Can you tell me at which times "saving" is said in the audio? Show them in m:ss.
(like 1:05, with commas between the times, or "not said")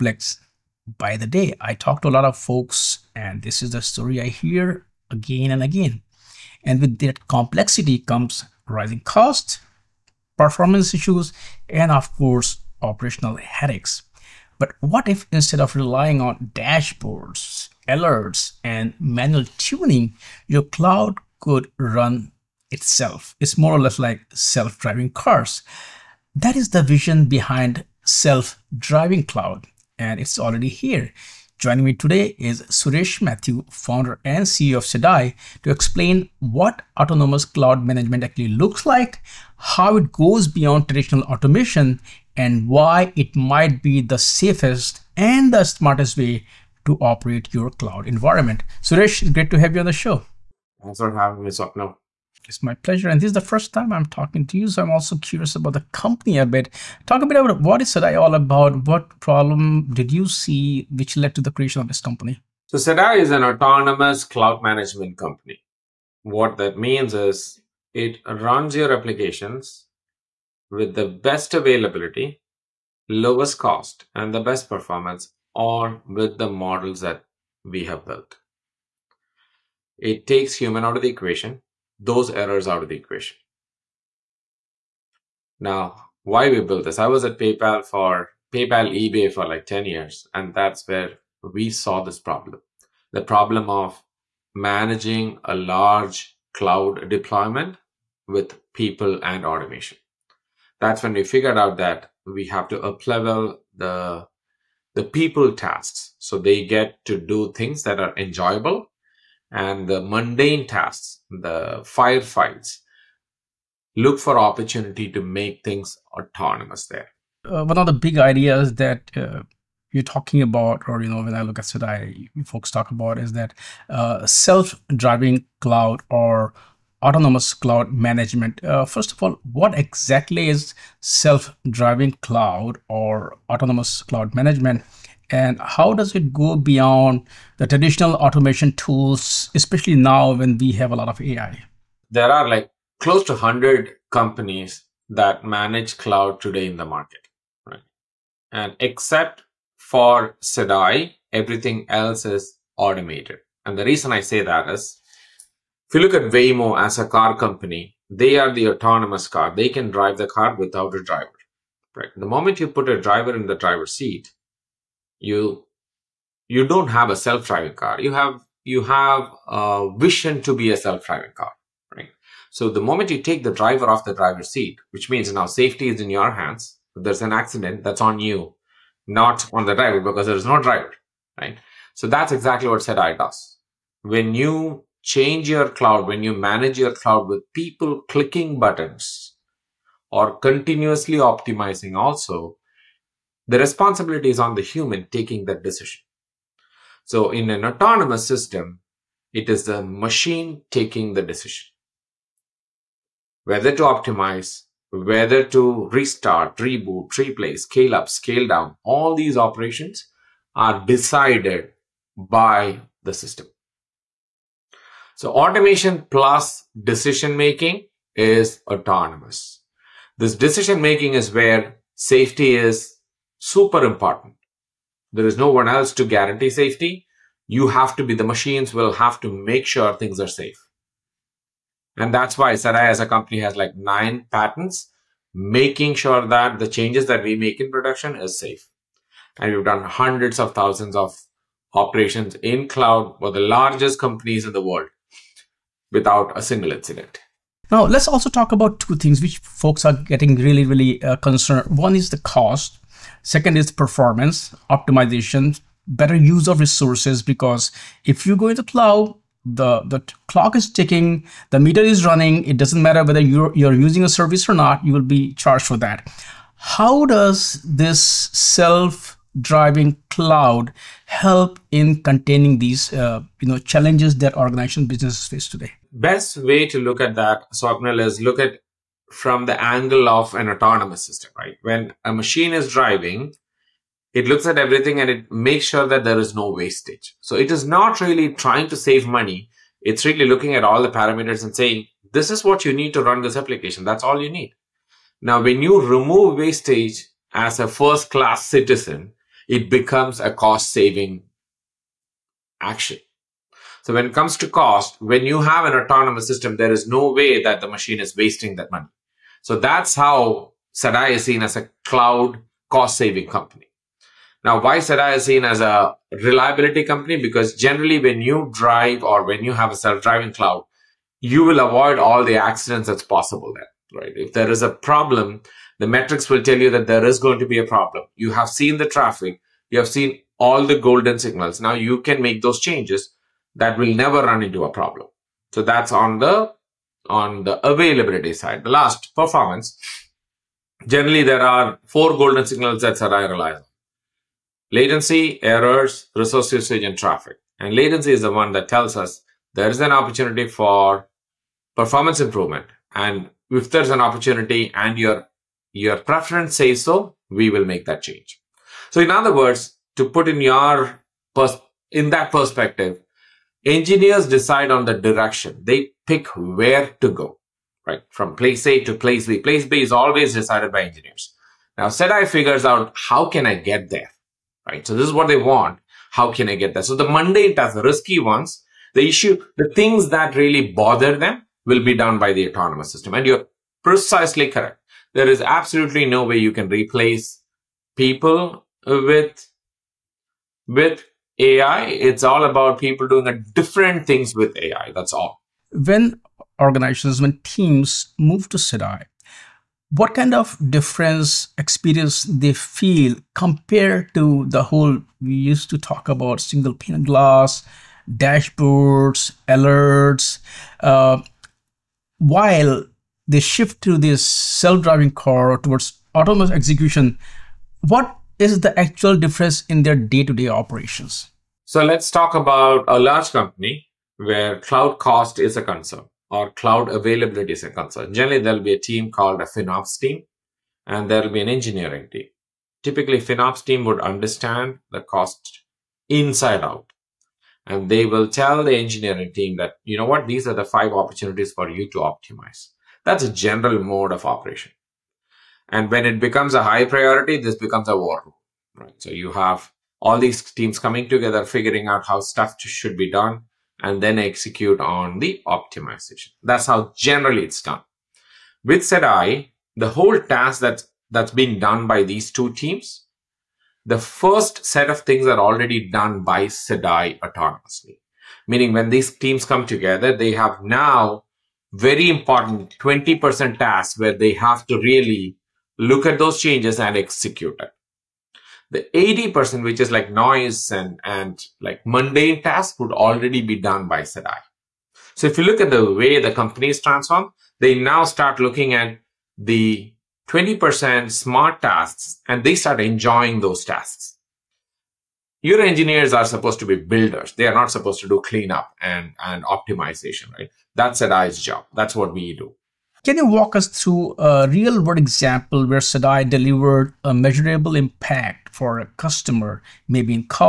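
5:00, 5:12.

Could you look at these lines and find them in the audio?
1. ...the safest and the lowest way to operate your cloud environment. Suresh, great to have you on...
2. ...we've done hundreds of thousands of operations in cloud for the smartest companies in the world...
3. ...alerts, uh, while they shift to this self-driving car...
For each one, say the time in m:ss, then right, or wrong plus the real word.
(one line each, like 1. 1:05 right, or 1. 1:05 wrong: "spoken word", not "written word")
1. 0:44 wrong: "smartest", not "lowest"
2. 3:59 wrong: "largest", not "smartest"
3. 6:49 right.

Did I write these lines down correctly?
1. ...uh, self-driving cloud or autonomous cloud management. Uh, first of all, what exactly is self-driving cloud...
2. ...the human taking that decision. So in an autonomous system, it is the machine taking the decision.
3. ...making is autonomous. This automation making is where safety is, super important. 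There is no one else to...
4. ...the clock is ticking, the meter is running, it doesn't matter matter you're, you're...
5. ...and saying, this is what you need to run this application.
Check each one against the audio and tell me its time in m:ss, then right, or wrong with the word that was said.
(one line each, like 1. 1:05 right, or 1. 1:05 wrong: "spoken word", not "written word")
1. 2:03 right
2. 3:14 right
3. 3:37 wrong: "decision", not "automation"
4. 4:19 wrong: "whether", not "matter"
5. 4:51 right.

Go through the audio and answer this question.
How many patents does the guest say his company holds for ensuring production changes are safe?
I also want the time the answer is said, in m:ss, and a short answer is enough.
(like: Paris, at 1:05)
9, at 3:53.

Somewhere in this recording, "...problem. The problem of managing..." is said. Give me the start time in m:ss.
1:32.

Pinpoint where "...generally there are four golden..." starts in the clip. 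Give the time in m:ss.
5:40.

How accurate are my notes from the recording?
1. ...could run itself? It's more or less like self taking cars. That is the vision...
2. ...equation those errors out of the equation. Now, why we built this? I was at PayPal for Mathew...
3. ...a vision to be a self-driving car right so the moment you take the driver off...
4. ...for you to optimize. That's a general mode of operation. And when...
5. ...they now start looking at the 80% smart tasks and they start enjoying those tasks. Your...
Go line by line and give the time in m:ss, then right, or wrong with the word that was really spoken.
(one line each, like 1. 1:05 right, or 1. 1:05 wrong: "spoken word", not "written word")
1. 0:21 wrong: "driving", not "taking"
2. 1:21 wrong: "PayPal", not "Mathew"
3. 2:49 right
4. 7:21 right
5. 8:07 wrong: "20", not "80".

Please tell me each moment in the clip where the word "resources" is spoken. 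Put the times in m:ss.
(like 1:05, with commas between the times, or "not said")
4:16, 5:46.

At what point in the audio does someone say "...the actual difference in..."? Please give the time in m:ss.
6:58.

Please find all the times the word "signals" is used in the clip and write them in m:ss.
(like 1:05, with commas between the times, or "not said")
5:31, 5:42.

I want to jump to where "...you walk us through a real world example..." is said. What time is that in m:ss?
8:23.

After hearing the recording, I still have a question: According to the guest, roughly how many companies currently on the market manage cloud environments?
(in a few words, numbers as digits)
100.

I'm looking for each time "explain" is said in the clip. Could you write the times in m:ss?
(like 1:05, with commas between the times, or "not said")
0:35.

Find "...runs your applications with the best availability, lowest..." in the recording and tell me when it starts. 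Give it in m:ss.
1:08.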